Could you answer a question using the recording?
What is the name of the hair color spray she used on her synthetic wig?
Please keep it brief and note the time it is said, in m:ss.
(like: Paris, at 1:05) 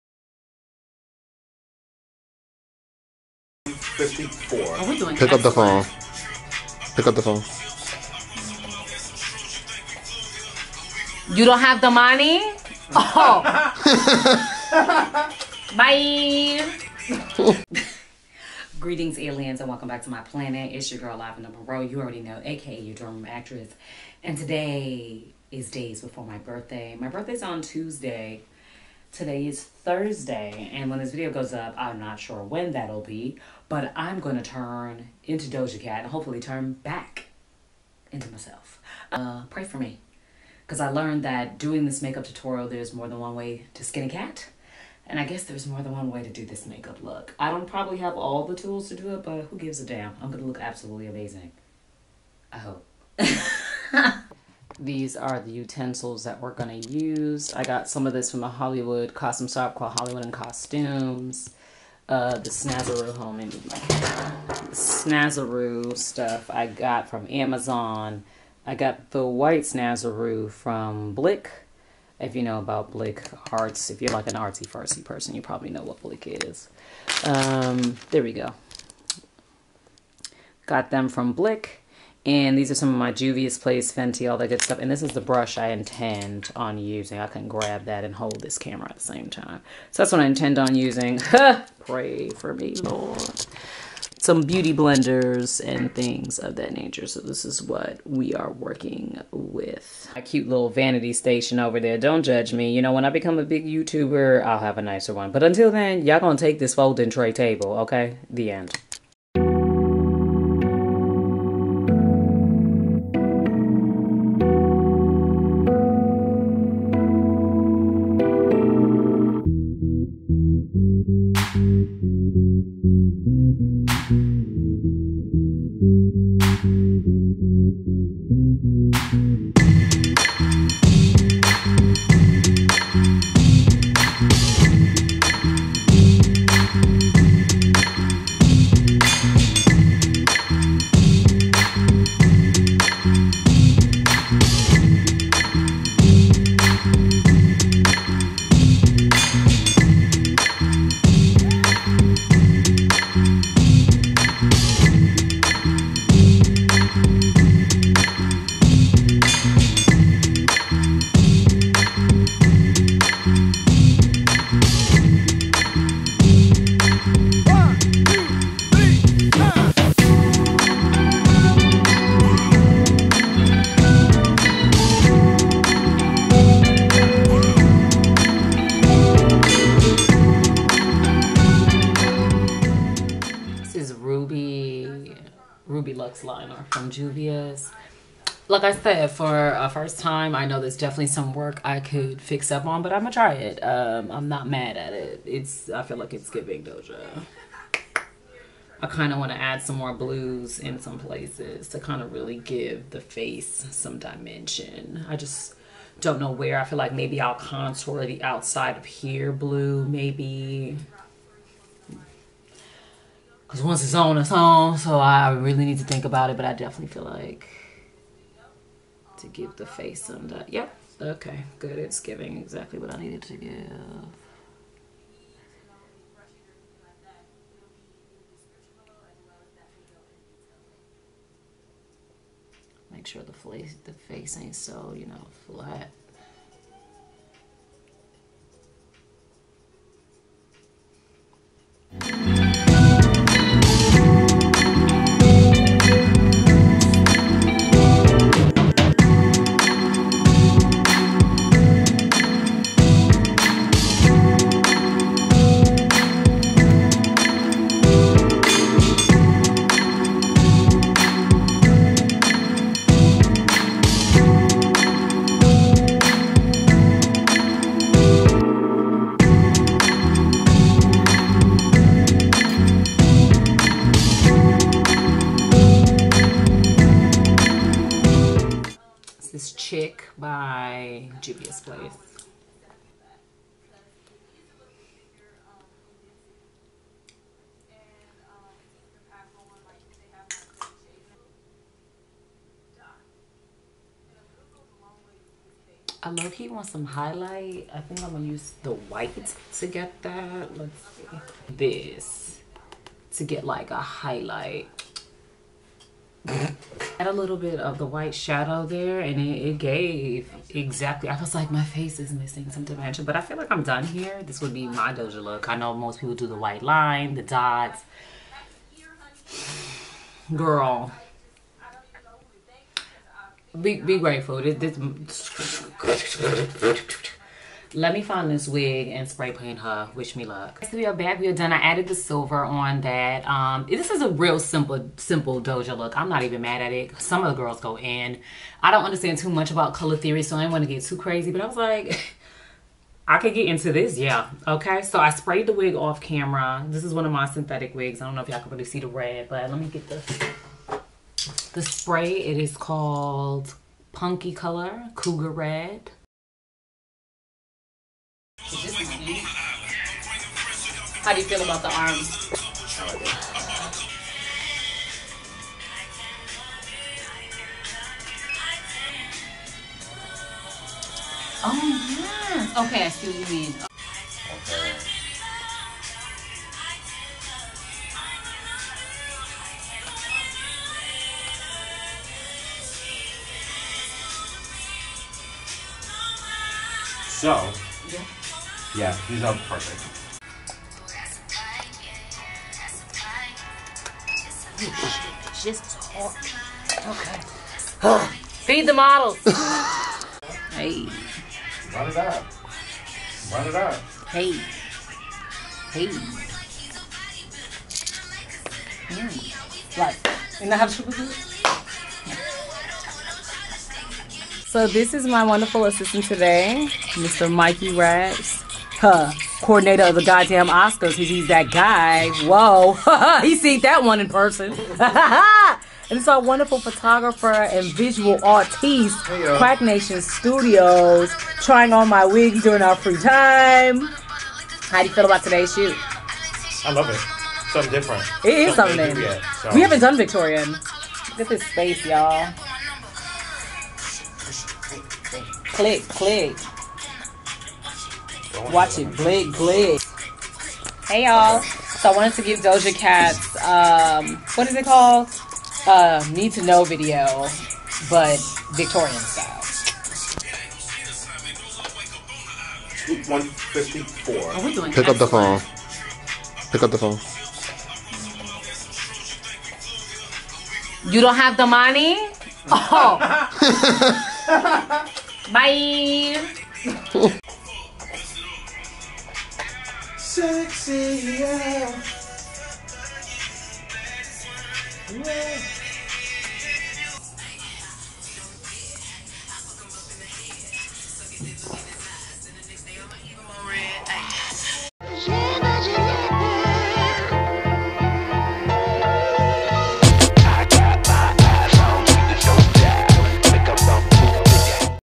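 Punky Color Cougar Red, at 5:53.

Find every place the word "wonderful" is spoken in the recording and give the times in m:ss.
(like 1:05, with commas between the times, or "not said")
6:55, 7:06.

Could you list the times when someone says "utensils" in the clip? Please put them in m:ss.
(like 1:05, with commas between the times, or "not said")
0:55.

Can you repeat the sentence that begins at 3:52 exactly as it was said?
Make sure the face the face ain't so you know flat.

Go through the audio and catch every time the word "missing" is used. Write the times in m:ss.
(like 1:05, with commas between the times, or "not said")
5:12.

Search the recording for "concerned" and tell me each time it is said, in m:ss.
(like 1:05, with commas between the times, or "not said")
not said.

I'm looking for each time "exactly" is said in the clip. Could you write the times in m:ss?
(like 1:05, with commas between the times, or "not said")
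3:42, 5:10.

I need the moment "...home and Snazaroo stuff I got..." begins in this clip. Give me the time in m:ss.
1:03.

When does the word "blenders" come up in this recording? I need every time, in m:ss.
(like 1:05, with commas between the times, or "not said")
1:34.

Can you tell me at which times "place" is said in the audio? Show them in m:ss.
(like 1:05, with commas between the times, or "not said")
1:23, 3:20, 4:41.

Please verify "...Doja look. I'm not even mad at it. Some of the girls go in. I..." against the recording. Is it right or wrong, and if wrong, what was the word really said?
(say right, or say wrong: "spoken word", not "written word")
right.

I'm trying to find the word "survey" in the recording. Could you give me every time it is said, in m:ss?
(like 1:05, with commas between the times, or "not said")
not said.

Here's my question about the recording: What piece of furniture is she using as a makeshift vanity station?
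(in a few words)
folding tray table.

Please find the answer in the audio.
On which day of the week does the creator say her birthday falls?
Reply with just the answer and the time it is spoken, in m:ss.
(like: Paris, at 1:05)
Tuesday, at 0:27.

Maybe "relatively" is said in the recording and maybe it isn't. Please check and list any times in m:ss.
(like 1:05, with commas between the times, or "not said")
not said.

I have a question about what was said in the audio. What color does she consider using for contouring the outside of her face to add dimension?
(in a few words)
blue.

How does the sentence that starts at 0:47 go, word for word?
I don't probably have all the tools to do it, but who gives a damn?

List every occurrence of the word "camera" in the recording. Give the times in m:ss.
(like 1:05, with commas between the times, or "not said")
1:28, 5:46.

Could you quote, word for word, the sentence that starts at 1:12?
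If you know about Blick Arts, if you're like an artsy fartsy person, you probably know what Blick is.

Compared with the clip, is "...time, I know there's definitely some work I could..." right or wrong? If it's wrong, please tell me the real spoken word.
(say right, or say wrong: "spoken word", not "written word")
right.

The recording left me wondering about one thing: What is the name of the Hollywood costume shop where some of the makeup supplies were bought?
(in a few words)
Hollywood and Costumes.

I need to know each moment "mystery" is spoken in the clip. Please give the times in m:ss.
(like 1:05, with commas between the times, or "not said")
not said.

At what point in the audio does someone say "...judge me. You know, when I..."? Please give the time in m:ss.
1:42.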